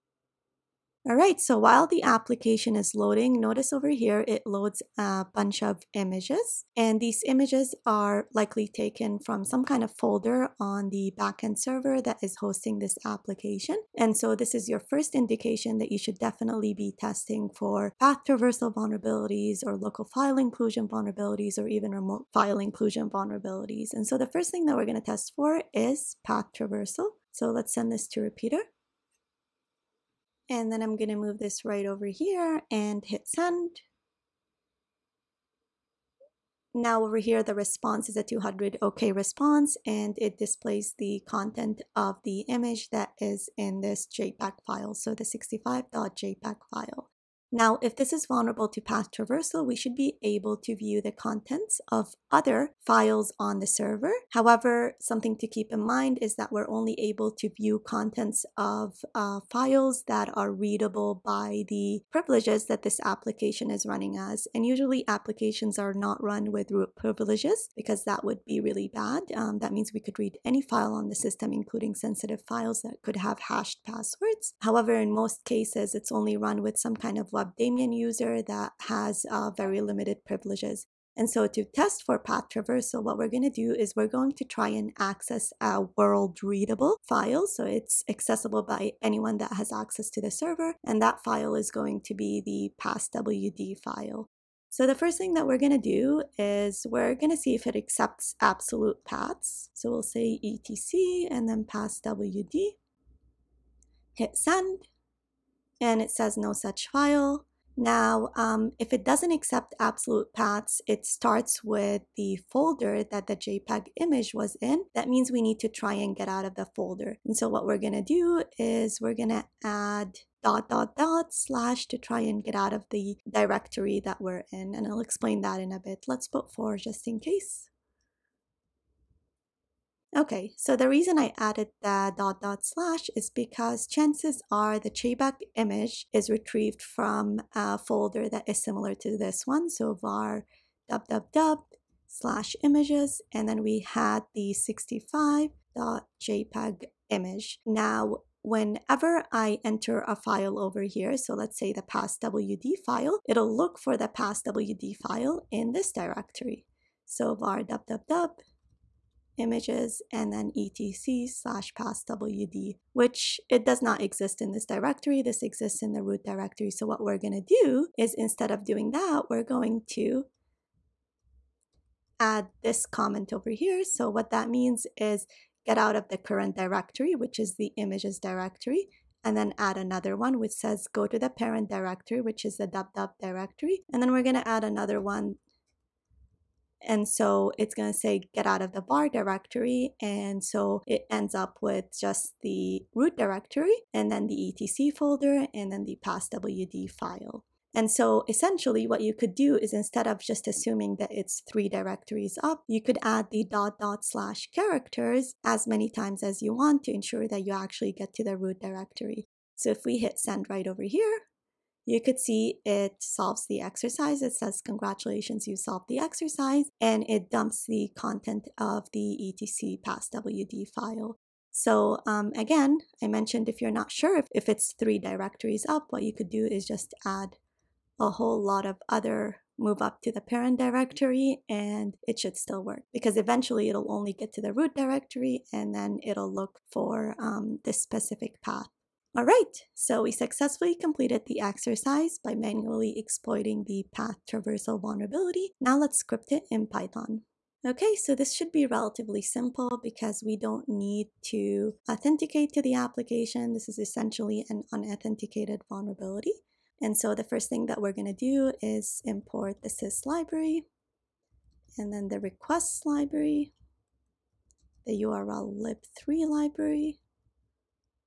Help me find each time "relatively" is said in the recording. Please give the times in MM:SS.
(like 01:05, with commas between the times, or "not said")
04:08.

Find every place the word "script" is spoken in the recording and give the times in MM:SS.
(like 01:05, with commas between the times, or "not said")
04:05.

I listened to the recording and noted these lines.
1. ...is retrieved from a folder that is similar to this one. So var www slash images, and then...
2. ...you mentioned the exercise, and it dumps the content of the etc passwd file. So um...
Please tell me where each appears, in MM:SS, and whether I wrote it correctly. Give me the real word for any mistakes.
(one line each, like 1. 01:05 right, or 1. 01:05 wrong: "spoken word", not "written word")
1. 02:16 right
2. 03:35 wrong: "solved", not "mentioned".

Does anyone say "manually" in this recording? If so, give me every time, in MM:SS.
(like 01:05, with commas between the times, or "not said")
04:02.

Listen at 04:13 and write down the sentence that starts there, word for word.
This is essentially an unauthenticated vulnerability.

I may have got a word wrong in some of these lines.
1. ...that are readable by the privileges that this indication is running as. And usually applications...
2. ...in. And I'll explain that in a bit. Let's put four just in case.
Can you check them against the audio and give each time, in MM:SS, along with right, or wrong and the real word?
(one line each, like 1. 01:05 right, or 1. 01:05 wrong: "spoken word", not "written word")
1. 01:00 wrong: "application", not "indication"
2. 02:04 right.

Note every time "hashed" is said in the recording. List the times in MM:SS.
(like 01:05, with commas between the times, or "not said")
01:13.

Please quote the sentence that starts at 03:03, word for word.
And then we're going to add another one and so it's going to say get out of the var directory.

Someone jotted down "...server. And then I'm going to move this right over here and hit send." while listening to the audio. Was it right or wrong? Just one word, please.
wrong.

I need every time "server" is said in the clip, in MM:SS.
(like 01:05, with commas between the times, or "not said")
00:11, 00:53, 01:30.